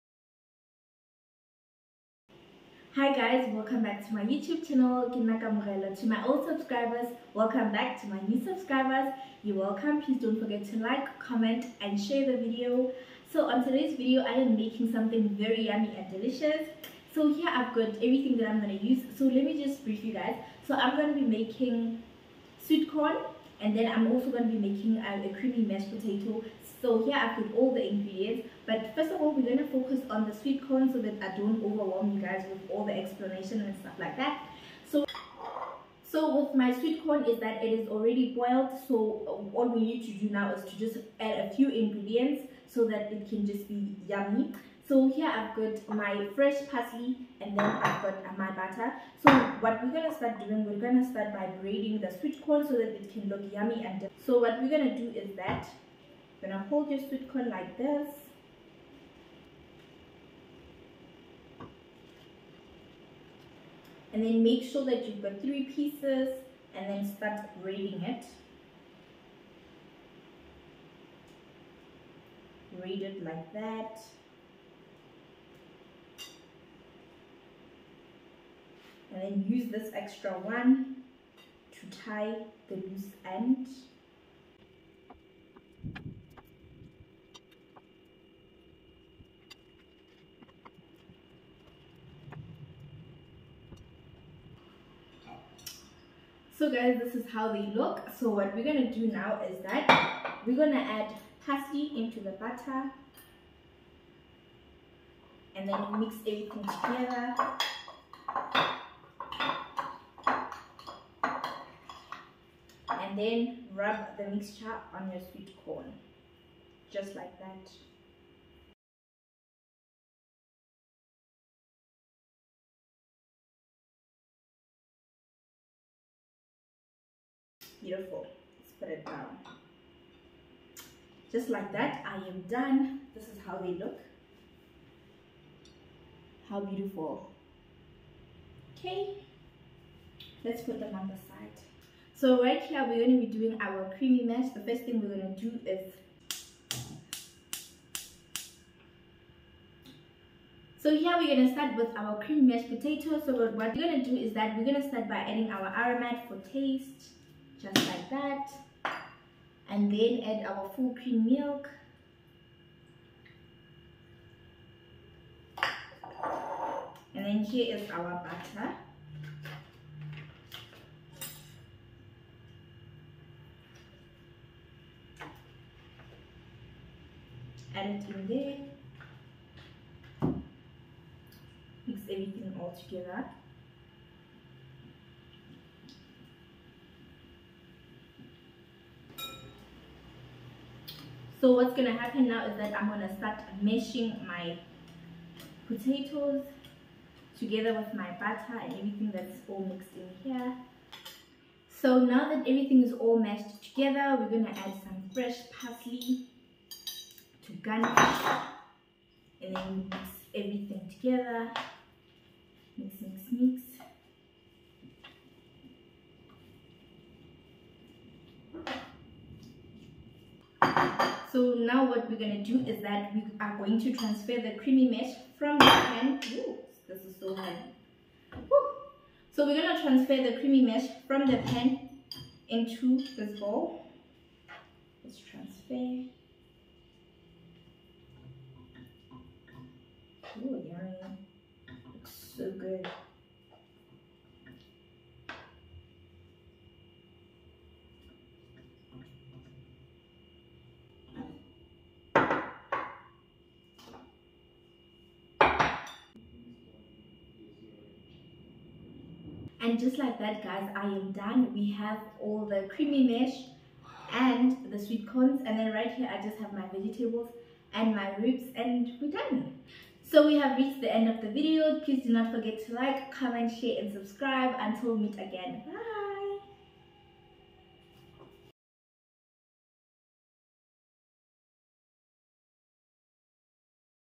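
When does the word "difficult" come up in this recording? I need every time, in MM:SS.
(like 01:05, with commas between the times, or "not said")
not said.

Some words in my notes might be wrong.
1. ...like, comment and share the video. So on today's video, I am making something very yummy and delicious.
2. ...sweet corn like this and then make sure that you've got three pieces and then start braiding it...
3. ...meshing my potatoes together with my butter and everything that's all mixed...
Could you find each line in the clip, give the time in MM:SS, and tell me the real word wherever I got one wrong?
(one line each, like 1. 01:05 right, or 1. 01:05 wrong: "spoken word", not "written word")
1. 00:10 right
2. 00:56 right
3. 03:13 right.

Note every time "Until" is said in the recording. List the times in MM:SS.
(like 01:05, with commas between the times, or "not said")
04:34.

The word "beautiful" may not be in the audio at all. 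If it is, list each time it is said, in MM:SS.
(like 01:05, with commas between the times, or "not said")
02:07, 02:16.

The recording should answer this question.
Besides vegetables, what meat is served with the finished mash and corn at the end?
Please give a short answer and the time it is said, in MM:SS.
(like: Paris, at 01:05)
Ribs, at 04:28.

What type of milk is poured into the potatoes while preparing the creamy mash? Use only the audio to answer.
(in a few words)
Full cream milk.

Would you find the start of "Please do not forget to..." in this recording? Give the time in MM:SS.
04:31.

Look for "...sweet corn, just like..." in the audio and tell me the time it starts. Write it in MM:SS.
01:55.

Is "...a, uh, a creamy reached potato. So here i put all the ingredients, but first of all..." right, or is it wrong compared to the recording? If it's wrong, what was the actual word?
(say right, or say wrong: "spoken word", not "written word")
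wrong: "mashed", not "reached".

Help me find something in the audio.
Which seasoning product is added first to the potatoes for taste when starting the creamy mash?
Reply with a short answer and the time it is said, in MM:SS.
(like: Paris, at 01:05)
Aromat, at 02:35.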